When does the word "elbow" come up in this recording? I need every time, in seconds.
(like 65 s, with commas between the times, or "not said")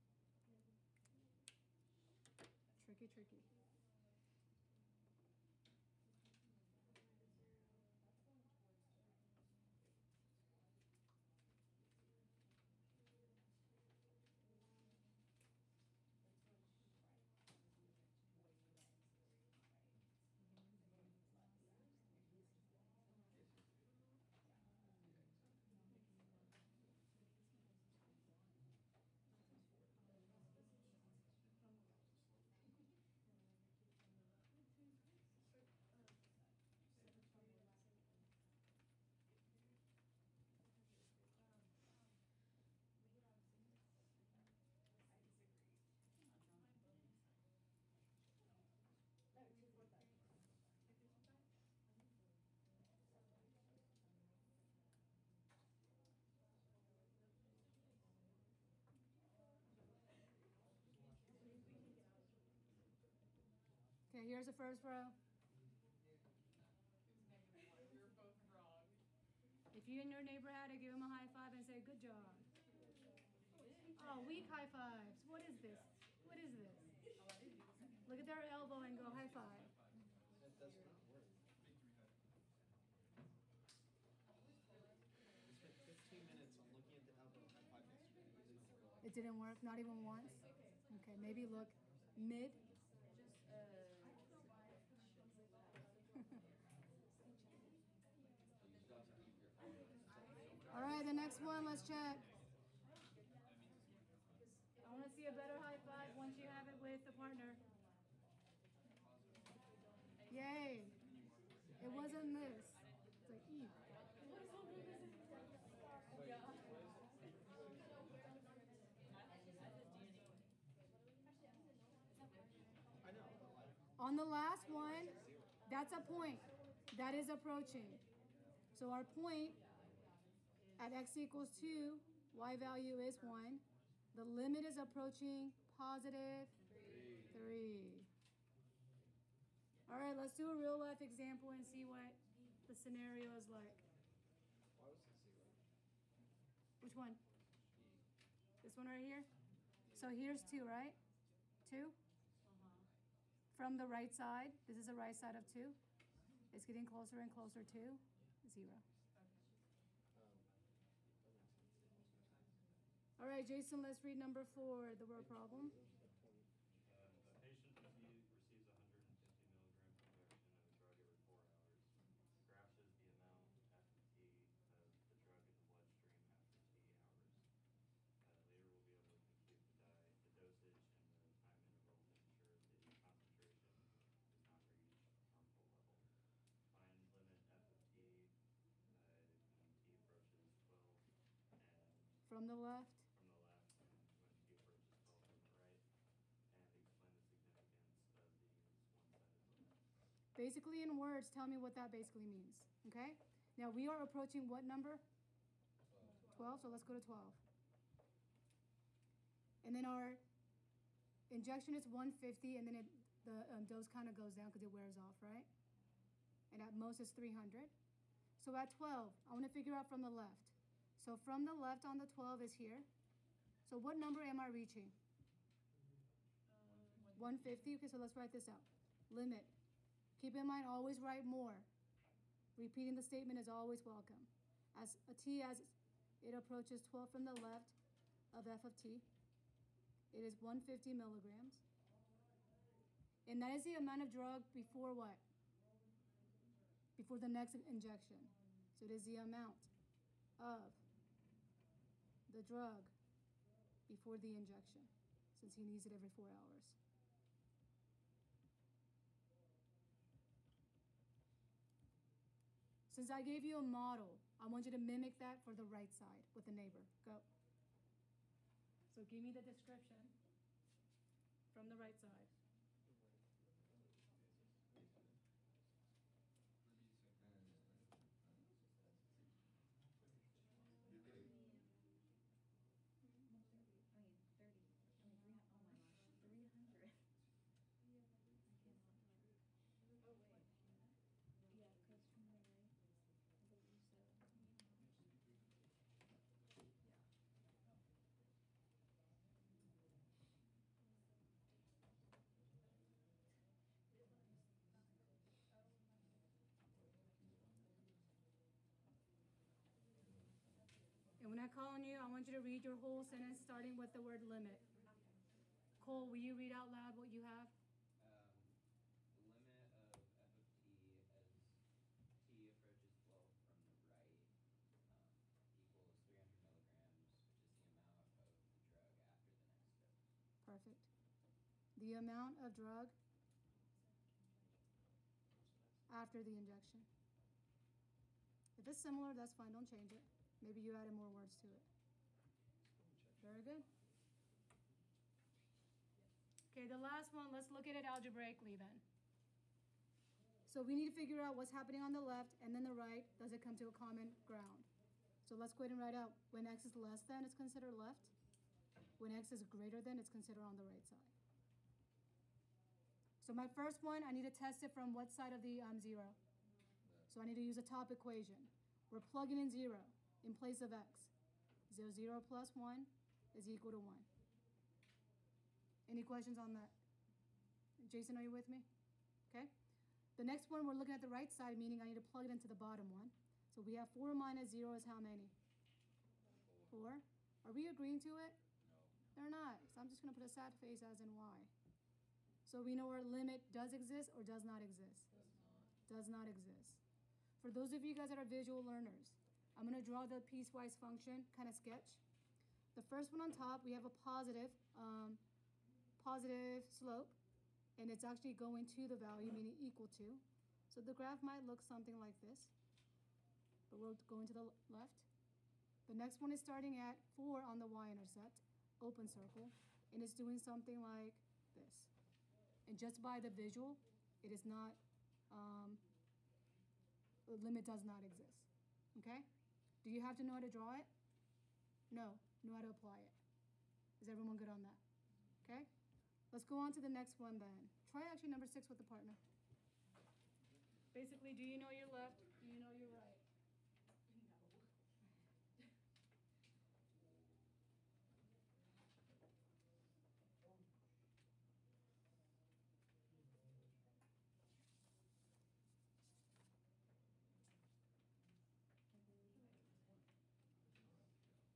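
78 s, 87 s.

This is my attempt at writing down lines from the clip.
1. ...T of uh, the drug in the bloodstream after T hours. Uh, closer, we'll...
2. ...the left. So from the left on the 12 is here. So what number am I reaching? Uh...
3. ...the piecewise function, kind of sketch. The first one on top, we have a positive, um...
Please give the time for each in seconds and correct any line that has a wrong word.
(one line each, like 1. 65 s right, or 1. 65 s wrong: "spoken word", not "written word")
1. 174 s wrong: "later", not "closer"
2. 220 s right
3. 400 s right.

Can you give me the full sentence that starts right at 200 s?
Basically in words, tell me what that basically means, okay?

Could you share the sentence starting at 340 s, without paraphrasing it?
Maybe you added more words to it.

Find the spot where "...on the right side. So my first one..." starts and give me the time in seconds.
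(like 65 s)
360 s.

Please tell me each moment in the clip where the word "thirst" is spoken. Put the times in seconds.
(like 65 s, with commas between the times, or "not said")
not said.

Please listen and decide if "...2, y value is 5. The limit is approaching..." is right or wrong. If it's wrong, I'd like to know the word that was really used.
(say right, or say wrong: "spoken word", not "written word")
wrong: "1", not "5".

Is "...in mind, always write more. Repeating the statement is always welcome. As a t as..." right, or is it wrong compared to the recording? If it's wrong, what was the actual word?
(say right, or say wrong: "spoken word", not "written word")
right.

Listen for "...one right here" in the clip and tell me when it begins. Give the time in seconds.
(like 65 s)
148 s.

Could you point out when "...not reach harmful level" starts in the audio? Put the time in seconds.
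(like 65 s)
184 s.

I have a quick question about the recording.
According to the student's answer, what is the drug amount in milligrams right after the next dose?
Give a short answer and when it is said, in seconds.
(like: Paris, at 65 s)
300, at 326 s.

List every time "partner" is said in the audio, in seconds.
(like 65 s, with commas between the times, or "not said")
107 s, 438 s.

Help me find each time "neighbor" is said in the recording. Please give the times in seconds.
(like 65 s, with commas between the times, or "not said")
70 s, 266 s.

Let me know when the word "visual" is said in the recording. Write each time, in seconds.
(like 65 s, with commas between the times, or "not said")
398 s, 423 s.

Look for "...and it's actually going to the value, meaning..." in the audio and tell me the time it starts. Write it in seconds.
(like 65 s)
407 s.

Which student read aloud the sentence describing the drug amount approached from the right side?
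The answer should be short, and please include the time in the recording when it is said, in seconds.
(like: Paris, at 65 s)
Cole, at 315 s.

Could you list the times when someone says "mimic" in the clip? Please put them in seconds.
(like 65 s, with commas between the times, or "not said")
264 s.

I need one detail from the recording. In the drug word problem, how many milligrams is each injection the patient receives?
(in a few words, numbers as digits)
150.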